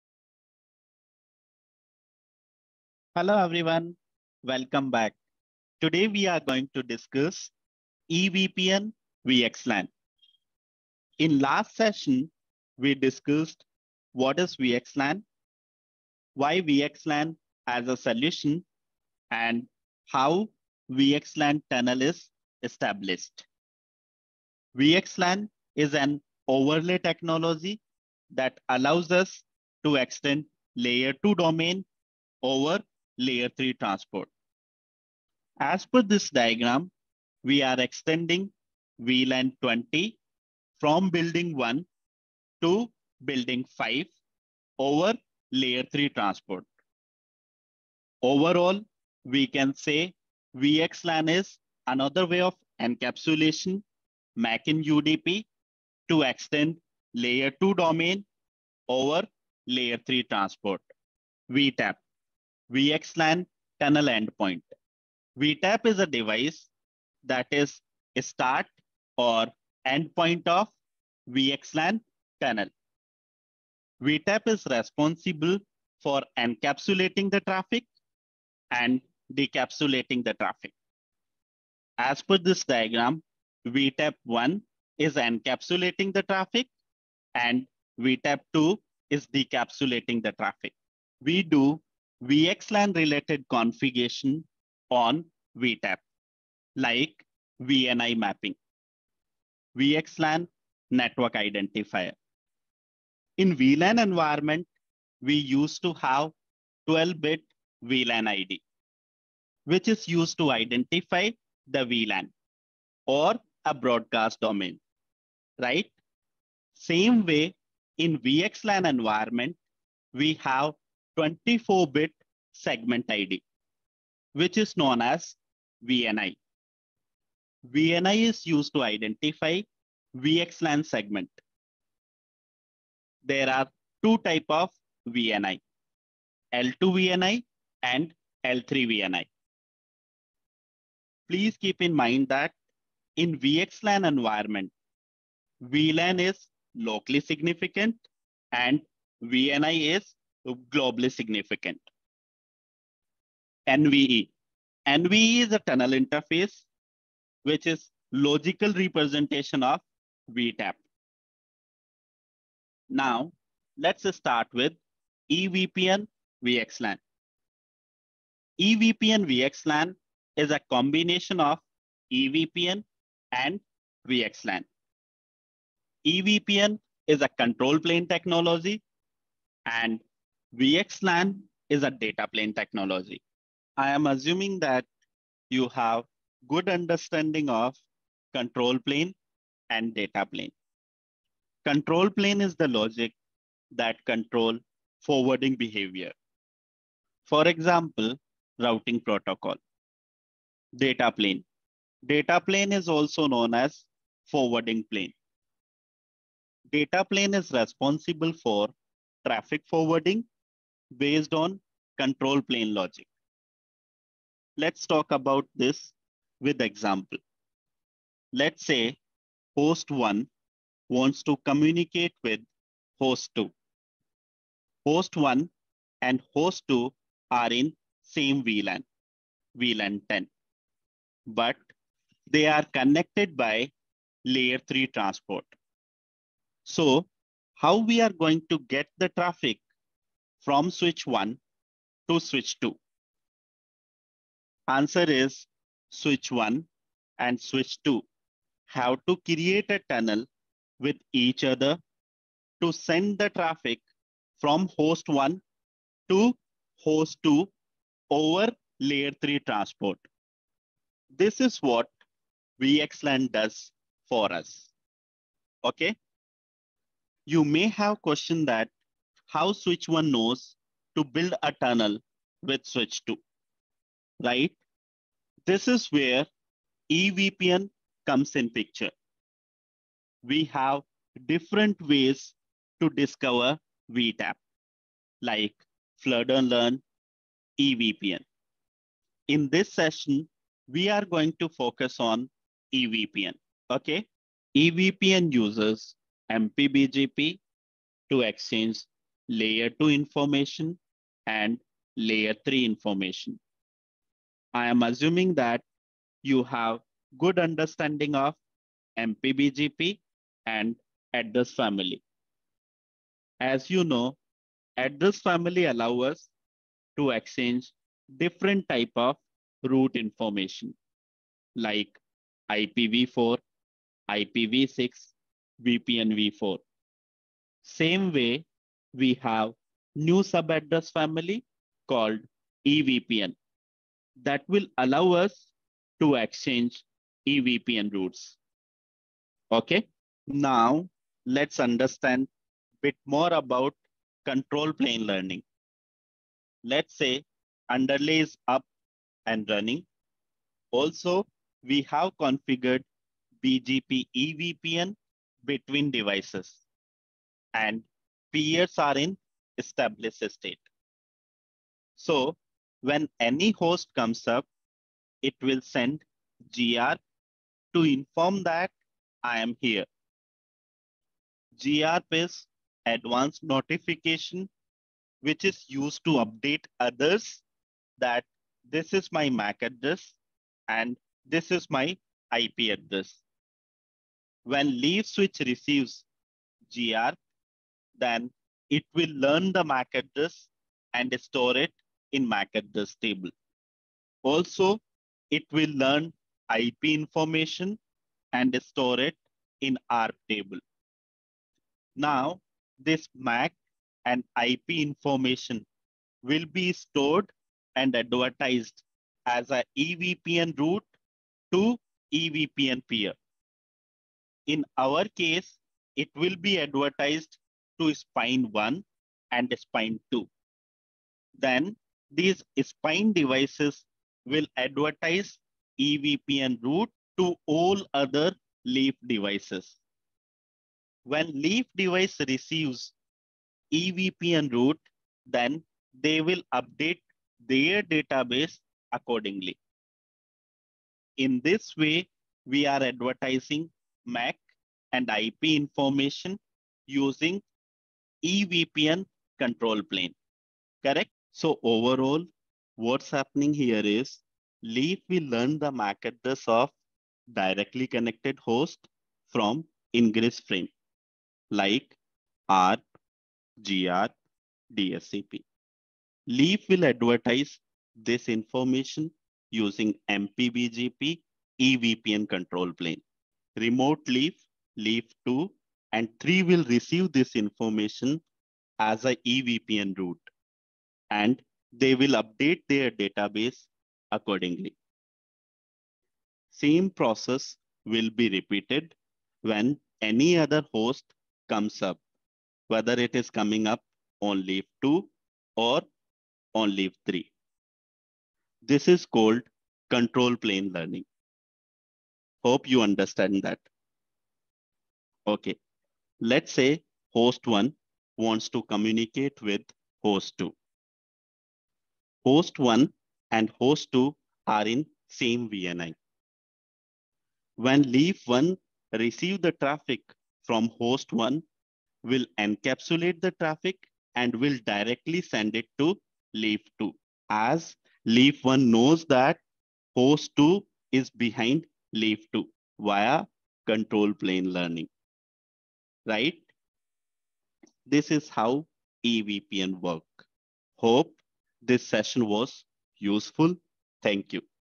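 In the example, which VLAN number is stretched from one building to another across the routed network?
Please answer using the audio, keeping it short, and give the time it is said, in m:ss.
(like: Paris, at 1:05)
20, at 0:39.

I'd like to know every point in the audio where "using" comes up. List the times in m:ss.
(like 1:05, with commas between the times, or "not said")
7:26, 7:49.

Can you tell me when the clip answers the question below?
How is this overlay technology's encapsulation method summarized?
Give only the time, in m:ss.
0:54.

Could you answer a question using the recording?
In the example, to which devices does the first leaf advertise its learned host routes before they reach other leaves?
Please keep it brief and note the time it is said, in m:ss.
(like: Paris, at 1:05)
spine 1 and spine 2, at 6:57.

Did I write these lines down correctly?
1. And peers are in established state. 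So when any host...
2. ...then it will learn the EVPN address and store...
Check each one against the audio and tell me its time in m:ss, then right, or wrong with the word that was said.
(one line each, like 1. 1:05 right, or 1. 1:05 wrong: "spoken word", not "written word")
1. 5:57 right
2. 6:28 wrong: "MAC", not "EVPN".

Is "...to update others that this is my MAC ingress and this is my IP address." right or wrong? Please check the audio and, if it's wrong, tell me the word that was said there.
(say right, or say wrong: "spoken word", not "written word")
wrong: "address", not "ingress".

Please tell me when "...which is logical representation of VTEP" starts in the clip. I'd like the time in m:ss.
2:37.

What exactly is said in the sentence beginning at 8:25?
Okay, Let's say host one wants to communicate with host two.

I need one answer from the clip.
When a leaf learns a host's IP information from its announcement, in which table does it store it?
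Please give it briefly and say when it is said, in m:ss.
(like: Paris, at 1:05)
ARP table, at 6:39.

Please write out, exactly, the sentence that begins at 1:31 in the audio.
We do VXLAN related configuration on VTEP, like VNI mapping, VXLAN network identifier.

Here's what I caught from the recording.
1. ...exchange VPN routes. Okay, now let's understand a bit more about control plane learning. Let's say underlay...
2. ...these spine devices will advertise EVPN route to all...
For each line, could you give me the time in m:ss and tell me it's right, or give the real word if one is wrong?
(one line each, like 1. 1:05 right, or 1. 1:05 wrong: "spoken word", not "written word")
1. 5:36 wrong: "EVPN", not "VPN"
2. 7:02 right.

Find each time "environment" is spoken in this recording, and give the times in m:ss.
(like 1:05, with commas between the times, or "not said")
1:44, 1:58, 2:24.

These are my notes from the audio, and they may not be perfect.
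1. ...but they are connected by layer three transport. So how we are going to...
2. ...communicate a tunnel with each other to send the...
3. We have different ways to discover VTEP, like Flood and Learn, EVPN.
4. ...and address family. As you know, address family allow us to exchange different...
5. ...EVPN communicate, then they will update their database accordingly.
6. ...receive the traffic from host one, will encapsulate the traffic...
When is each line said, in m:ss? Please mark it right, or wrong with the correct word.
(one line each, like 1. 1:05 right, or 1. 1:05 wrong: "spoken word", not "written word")
1. 3:51 right
2. 4:09 wrong: "create", not "communicate"
3. 4:40 right
4. 5:10 right
5. 7:13 wrong: "route", not "communicate"
6. 8:38 right.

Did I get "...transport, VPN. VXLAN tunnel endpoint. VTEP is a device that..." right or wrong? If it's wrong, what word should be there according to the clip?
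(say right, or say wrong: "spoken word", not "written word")
wrong: "VTEP", not "VPN".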